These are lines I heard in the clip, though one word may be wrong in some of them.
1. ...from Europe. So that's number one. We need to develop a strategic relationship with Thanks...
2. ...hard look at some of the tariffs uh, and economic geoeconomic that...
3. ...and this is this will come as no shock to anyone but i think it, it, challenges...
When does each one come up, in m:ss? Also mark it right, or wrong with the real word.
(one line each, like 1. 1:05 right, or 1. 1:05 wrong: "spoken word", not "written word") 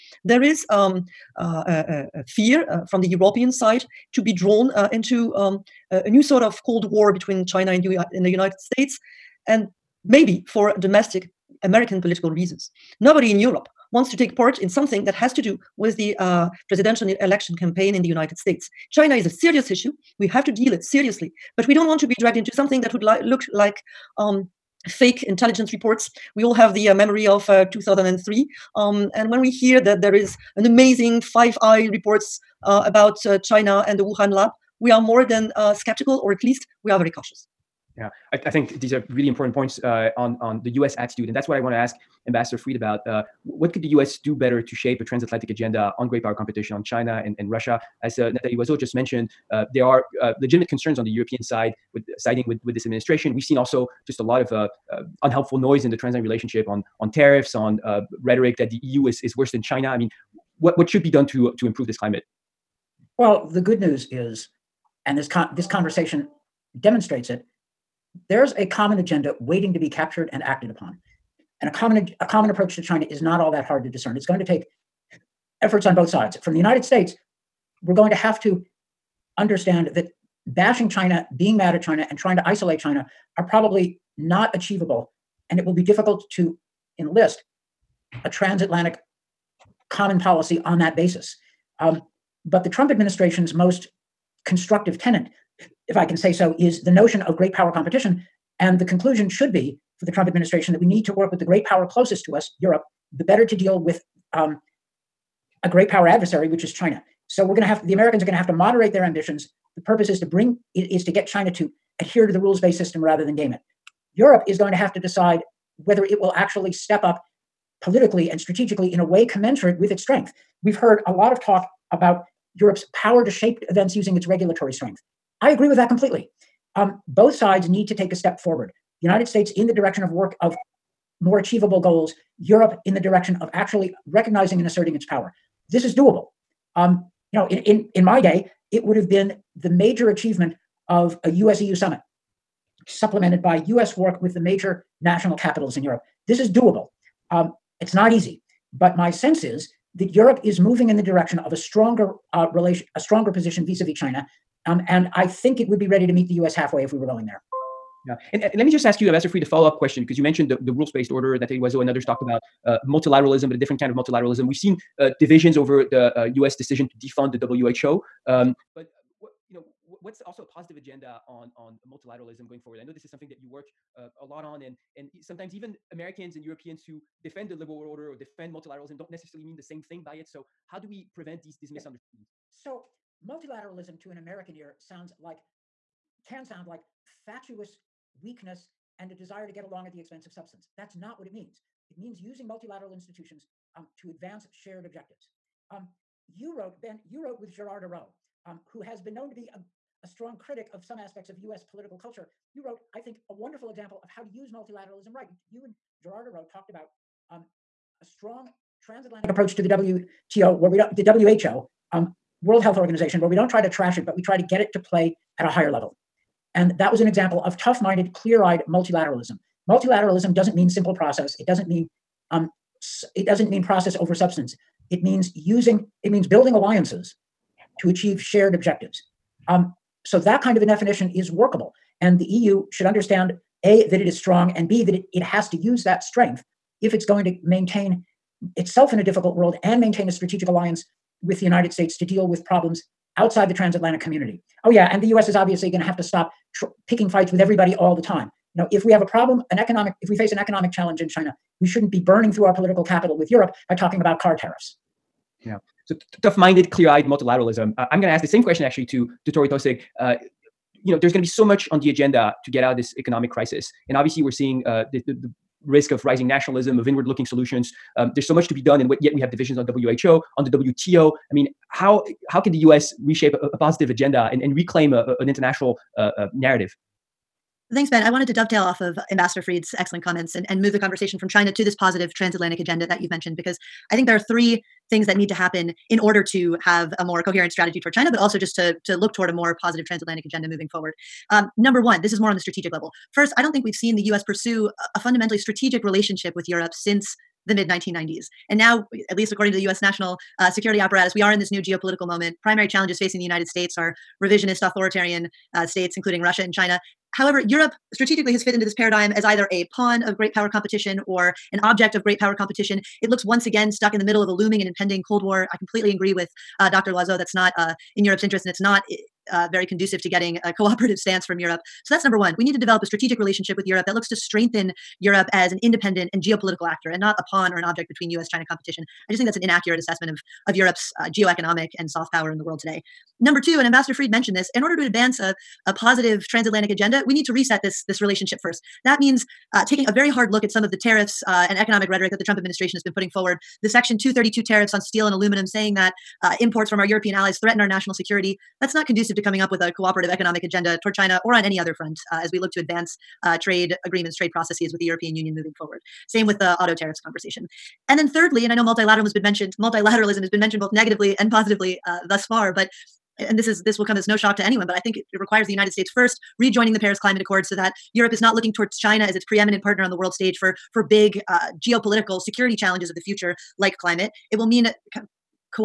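1. 5:21 wrong: "Europe", not "Thanks"
2. 5:40 wrong: "rhetoric", not "geoeconomic"
3. 6:03 wrong: "requires", not "challenges".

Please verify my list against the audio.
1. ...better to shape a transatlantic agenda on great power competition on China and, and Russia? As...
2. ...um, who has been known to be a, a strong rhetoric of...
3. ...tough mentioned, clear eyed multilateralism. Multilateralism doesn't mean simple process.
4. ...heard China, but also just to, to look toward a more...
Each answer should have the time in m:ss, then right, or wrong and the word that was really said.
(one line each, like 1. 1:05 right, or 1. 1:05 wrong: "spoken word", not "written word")
1. 0:44 right
2. 3:18 wrong: "critic", not "rhetoric"
3. 3:37 wrong: "minded", not "mentioned"
4. 4:47 wrong: "toward", not "heard".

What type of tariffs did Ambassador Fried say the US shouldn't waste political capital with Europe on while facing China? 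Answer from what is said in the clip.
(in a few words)
Car tariffs.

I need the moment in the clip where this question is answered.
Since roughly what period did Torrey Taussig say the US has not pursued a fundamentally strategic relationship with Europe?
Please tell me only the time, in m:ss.
4:57.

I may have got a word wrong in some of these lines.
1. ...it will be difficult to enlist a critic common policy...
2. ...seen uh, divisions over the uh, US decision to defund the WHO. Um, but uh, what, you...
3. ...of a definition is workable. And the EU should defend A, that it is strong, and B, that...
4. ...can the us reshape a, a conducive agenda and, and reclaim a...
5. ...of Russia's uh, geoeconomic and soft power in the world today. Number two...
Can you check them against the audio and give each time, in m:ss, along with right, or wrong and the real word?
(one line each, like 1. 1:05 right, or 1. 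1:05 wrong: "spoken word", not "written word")
1. 1:25 wrong: "transatlantic", not "critic"
2. 2:44 right
3. 3:50 wrong: "understand", not "defend"
4. 4:32 wrong: "positive", not "conducive"
5. 5:30 wrong: "Europe", not "Russia".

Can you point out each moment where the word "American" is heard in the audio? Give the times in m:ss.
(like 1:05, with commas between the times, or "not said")
0:11, 1:47, 2:55, 3:04.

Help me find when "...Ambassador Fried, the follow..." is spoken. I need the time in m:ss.
2:39.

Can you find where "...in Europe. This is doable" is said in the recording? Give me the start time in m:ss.
2:25.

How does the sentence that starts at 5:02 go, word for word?
Primary challenges facing the United States are revisionist, authoritarian uh, states, including Russia and China.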